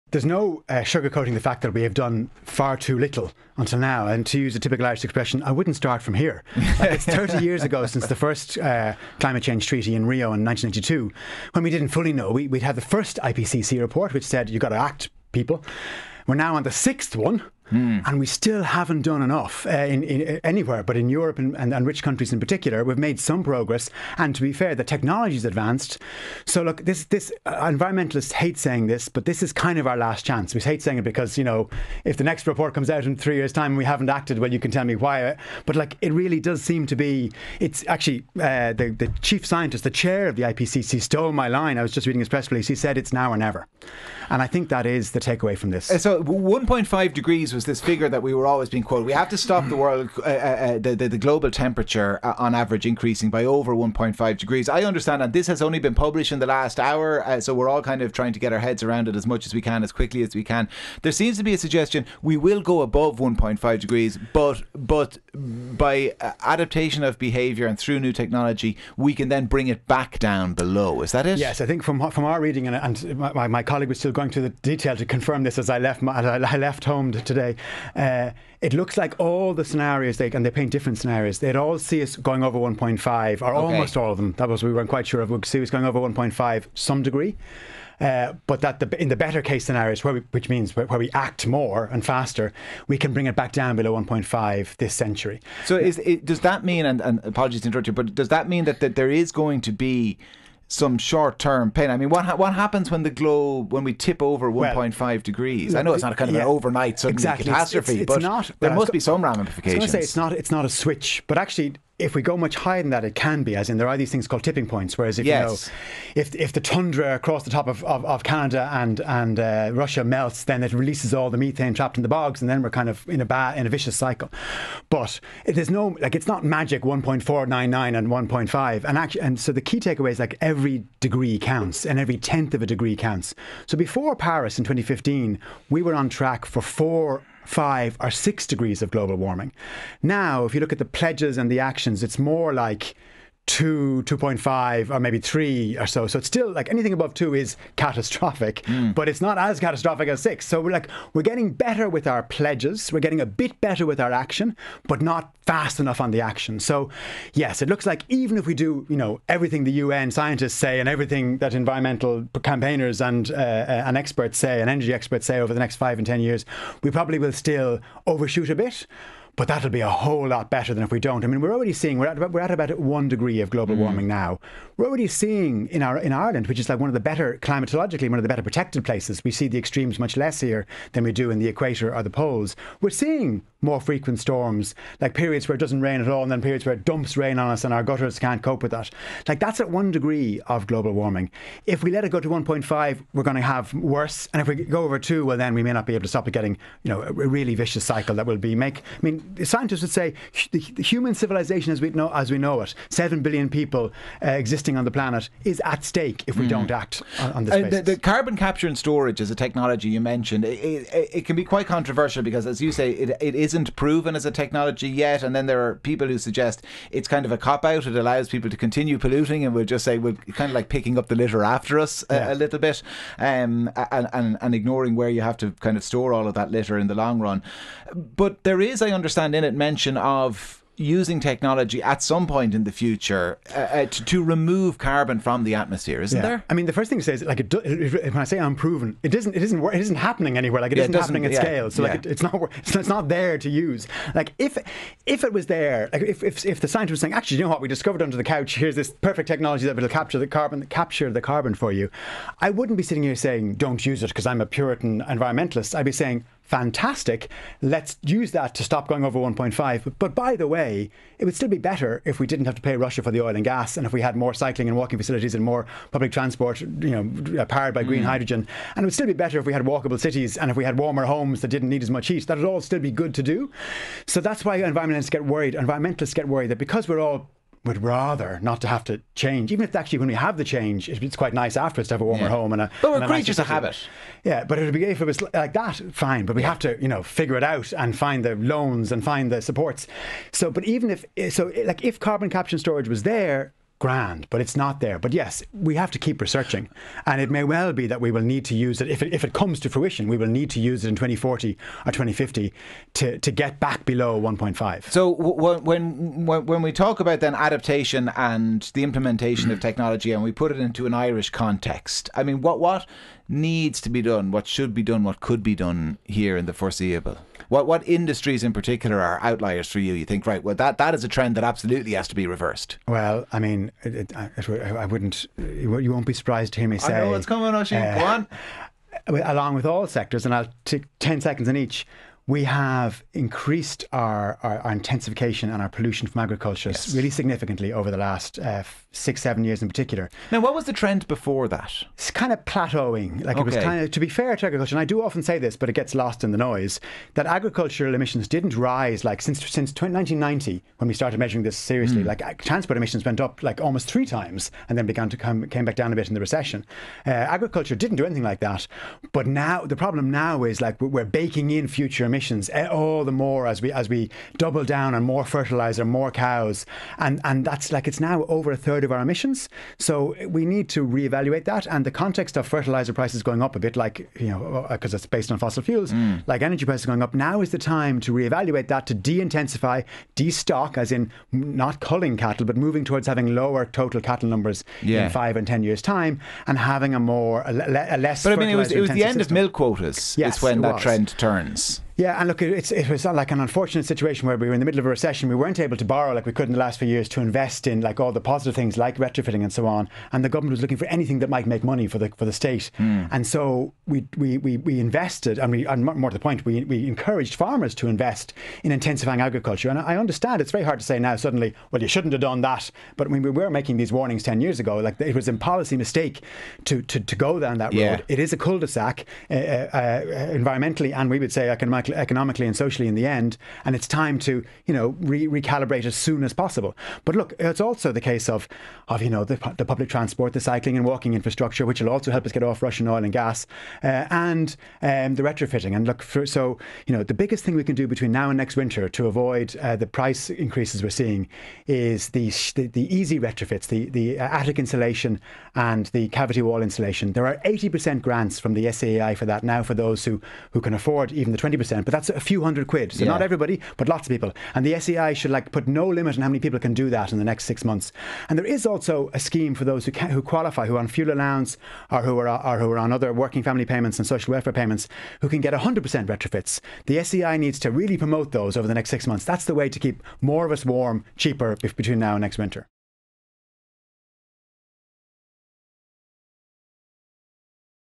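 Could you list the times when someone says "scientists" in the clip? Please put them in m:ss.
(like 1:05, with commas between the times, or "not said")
0:39, 2:40, 3:19, 4:06.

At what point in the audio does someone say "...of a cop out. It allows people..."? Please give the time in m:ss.
3:37.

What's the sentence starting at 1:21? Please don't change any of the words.
They'd all see us going over 1.5, or okay.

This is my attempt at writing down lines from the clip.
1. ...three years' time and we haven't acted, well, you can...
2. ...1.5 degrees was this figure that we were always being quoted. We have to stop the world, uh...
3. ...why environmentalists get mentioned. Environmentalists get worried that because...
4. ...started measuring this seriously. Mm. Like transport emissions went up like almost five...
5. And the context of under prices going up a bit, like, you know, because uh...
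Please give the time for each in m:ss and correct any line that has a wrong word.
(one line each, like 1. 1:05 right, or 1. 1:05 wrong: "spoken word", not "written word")
1. 0:33 right
2. 0:46 right
3. 4:34 wrong: "worried", not "mentioned"
4. 5:50 wrong: "three", not "five"
5. 6:11 wrong: "fertilizer", not "under".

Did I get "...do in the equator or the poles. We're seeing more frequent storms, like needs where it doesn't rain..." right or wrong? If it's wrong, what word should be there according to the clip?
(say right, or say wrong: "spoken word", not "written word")
wrong: "periods", not "needs".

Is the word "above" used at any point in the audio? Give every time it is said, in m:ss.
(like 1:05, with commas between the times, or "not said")
1:02, 2:26.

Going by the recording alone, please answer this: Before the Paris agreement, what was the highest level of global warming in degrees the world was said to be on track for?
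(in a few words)
6.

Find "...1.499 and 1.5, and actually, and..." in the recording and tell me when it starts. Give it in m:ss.
2:06.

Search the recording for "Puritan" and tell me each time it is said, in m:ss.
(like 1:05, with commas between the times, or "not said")
4:14.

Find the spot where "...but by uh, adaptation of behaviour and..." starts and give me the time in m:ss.
1:04.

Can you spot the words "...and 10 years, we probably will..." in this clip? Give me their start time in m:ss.
2:45.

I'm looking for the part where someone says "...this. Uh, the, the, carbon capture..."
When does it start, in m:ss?
3:27.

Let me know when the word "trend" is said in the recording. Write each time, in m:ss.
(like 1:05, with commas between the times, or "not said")
5:21, 5:40, 6:30.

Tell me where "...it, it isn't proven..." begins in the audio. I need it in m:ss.
3:32.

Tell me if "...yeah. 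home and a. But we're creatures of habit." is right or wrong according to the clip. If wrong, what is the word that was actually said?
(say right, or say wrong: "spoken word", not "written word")
right.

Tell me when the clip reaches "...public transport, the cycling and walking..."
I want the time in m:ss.
7:09.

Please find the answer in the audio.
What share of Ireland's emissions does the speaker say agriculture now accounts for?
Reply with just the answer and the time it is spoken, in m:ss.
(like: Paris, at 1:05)
over a third, at 6:08.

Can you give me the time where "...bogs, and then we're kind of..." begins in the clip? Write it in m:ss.
2:02.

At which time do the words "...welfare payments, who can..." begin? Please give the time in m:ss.
7:44.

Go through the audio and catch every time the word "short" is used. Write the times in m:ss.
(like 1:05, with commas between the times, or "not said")
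1:40.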